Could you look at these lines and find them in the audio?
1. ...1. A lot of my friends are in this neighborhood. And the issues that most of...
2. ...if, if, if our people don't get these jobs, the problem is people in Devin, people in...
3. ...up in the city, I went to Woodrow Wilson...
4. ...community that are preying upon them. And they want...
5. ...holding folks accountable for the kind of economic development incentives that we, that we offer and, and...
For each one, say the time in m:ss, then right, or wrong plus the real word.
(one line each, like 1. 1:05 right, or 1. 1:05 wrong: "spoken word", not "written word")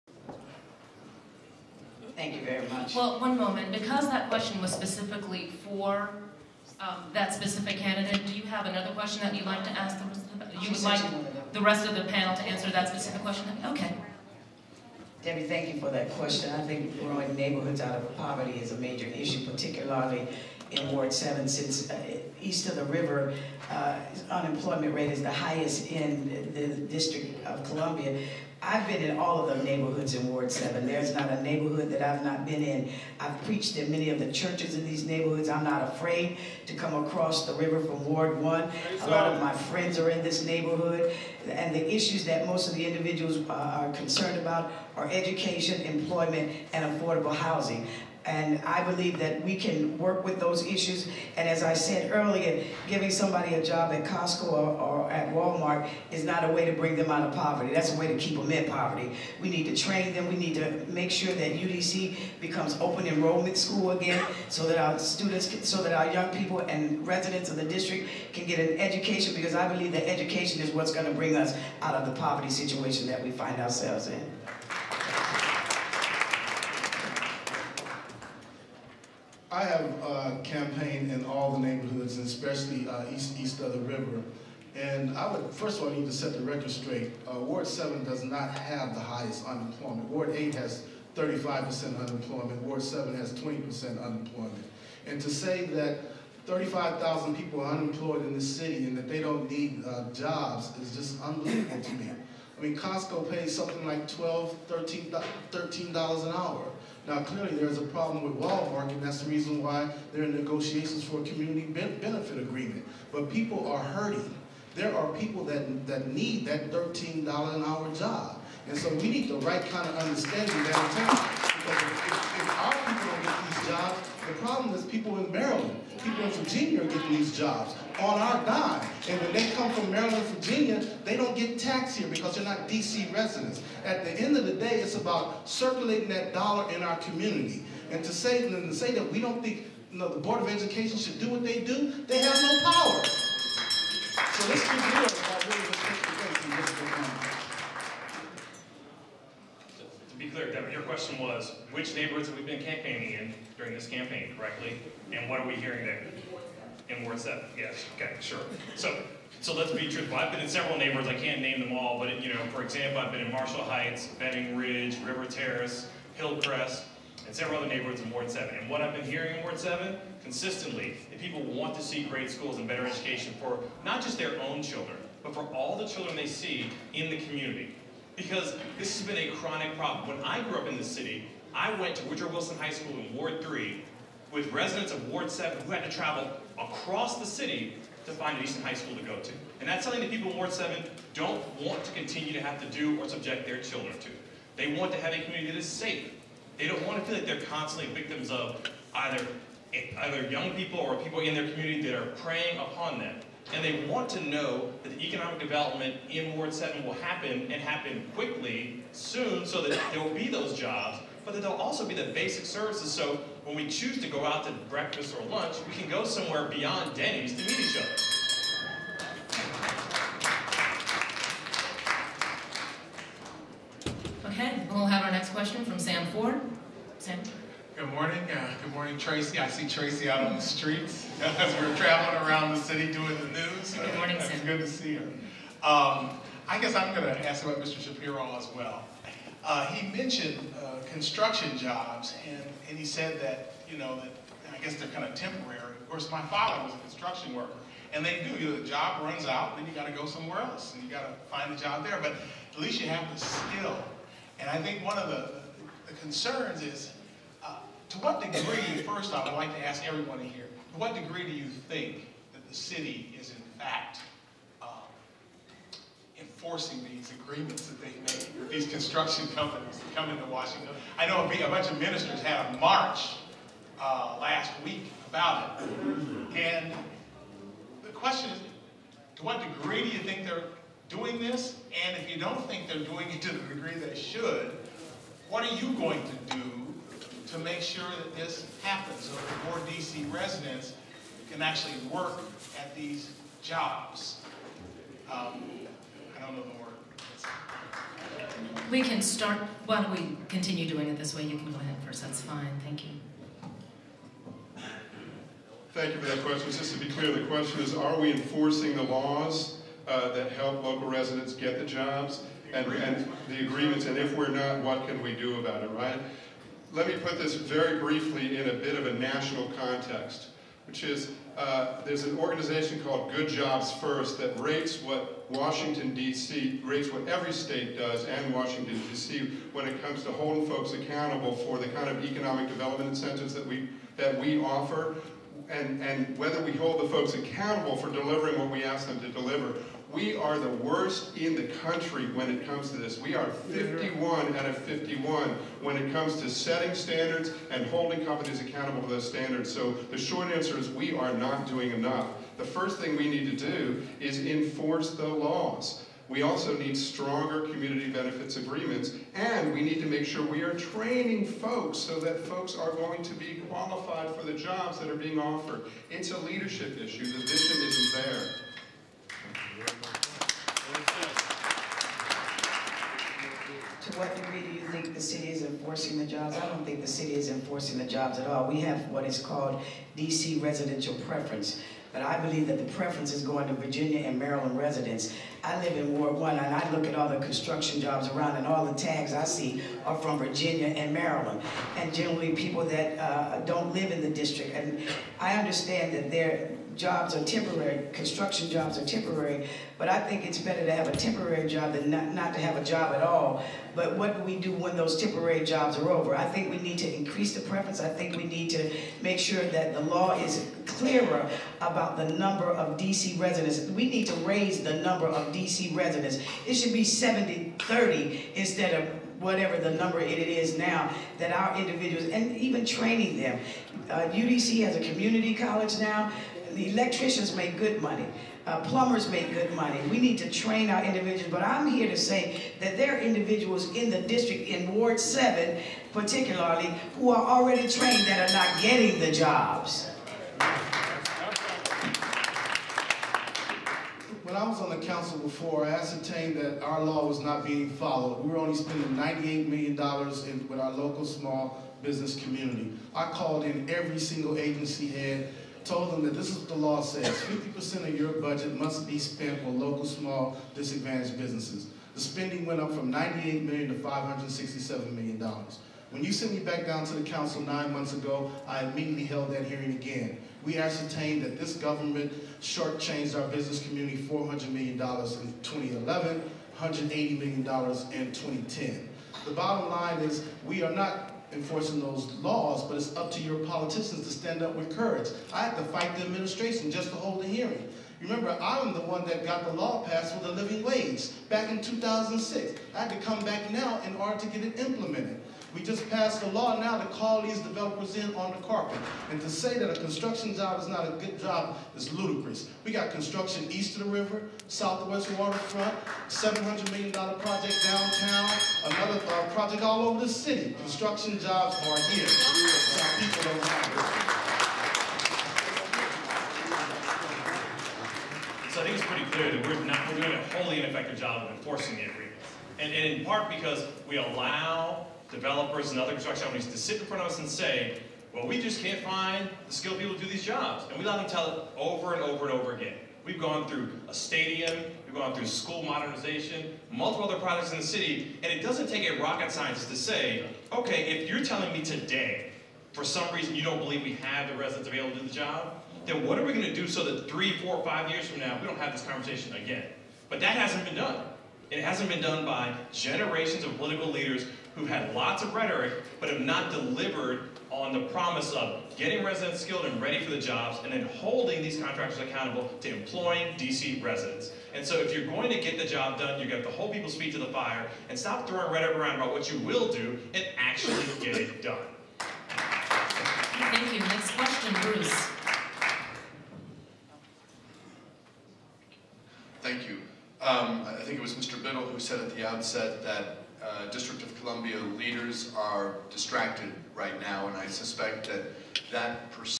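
1. 0:38 right
2. 2:01 wrong: "Maryland", not "Devin"
3. 3:00 right
4. 3:21 right
5. 5:30 right.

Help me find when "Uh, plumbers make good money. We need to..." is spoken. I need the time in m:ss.
7:08.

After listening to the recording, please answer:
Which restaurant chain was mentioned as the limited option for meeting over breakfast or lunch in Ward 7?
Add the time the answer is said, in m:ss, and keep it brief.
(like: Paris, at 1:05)
Denny's, at 3:36.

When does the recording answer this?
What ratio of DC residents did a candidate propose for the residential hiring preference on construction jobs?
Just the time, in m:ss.
6:56.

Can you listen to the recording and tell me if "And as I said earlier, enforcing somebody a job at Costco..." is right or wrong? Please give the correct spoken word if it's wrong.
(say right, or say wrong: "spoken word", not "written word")
wrong: "giving", not "enforcing".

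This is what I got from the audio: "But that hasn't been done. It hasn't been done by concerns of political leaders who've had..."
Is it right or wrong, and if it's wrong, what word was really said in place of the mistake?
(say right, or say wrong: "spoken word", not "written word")
wrong: "generations", not "concerns".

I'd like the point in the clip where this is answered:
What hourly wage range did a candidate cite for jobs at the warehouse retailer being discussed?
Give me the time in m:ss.
1:44.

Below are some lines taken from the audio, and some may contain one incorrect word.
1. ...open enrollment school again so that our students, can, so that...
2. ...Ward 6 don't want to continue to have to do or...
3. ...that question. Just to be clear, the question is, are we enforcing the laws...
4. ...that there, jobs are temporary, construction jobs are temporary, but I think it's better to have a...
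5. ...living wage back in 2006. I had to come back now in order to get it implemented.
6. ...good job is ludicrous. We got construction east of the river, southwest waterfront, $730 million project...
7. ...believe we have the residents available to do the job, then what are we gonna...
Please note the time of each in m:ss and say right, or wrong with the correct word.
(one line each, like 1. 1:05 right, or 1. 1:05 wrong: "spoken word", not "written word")
1. 1:02 right
2. 3:10 wrong: "7", not "6"
3. 5:06 right
4. 6:35 right
5. 8:10 right
6. 8:20 wrong: "700", not "730"
7. 9:03 right.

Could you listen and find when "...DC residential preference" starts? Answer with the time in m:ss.
6:19.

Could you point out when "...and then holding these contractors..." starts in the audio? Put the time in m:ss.
9:20.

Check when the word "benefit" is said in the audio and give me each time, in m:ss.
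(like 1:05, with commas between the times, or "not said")
1:51, 5:57.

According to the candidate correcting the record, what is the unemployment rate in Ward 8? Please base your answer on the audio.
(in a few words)
35%.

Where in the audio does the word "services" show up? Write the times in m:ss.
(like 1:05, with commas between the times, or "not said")
3:32.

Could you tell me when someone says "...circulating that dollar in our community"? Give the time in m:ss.
2:15.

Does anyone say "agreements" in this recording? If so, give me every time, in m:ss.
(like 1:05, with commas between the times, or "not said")
1:52, 4:27, 5:13, 5:58, 8:41.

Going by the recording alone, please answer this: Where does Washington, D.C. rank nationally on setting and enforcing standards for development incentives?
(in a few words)
51 out of 51.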